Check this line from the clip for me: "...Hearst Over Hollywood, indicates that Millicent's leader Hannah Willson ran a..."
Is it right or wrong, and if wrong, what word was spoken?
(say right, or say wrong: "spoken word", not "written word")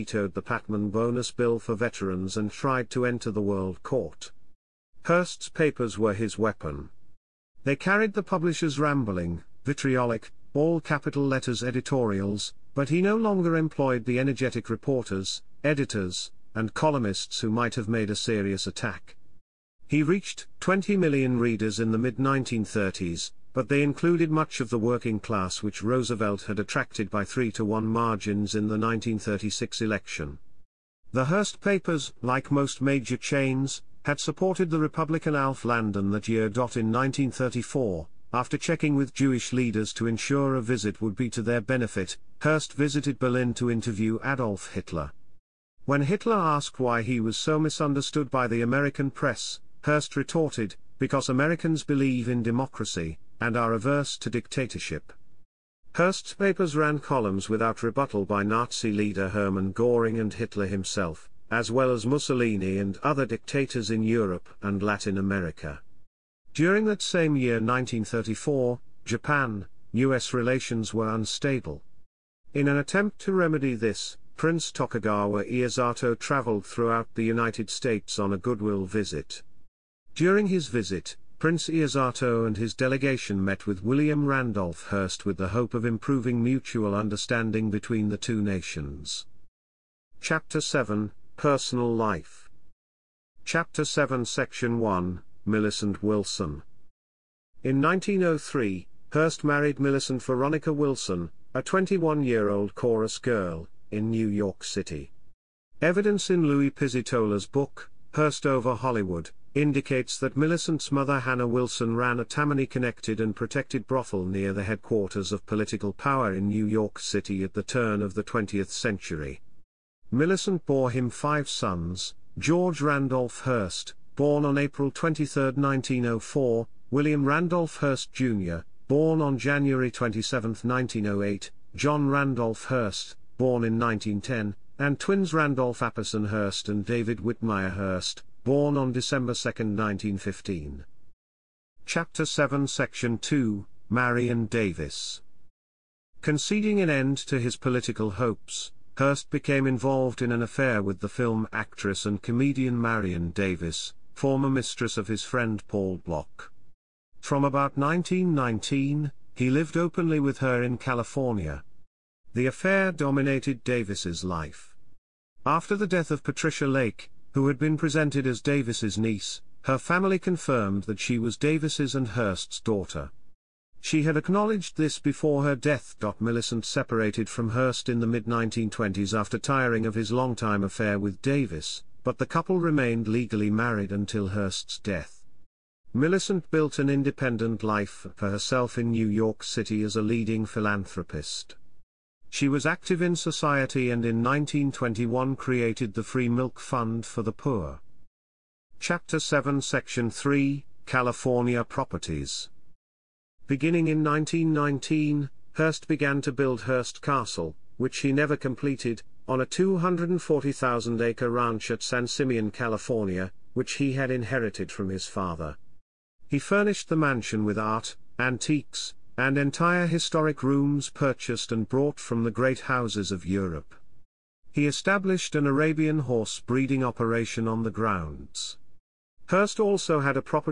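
wrong: "mother", not "leader".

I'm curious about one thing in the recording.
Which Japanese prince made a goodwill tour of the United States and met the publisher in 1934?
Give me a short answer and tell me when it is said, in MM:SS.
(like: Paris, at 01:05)
Tokugawa Iesato, at 01:14.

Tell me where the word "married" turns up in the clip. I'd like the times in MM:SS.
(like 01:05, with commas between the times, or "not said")
01:39, 03:03.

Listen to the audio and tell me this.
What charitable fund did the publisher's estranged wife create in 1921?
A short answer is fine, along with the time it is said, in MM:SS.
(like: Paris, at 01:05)
Free Milk Fund for the Poor, at 03:16.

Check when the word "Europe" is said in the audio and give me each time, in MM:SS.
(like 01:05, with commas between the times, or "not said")
01:04, 03:43.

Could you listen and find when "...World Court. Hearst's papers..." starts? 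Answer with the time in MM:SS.
00:03.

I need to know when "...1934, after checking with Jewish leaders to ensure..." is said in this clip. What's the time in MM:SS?
00:36.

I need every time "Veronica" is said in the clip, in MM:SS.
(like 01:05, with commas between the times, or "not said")
01:40.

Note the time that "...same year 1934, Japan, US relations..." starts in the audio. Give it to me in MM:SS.
01:07.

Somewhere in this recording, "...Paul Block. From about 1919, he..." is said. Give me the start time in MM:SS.
02:35.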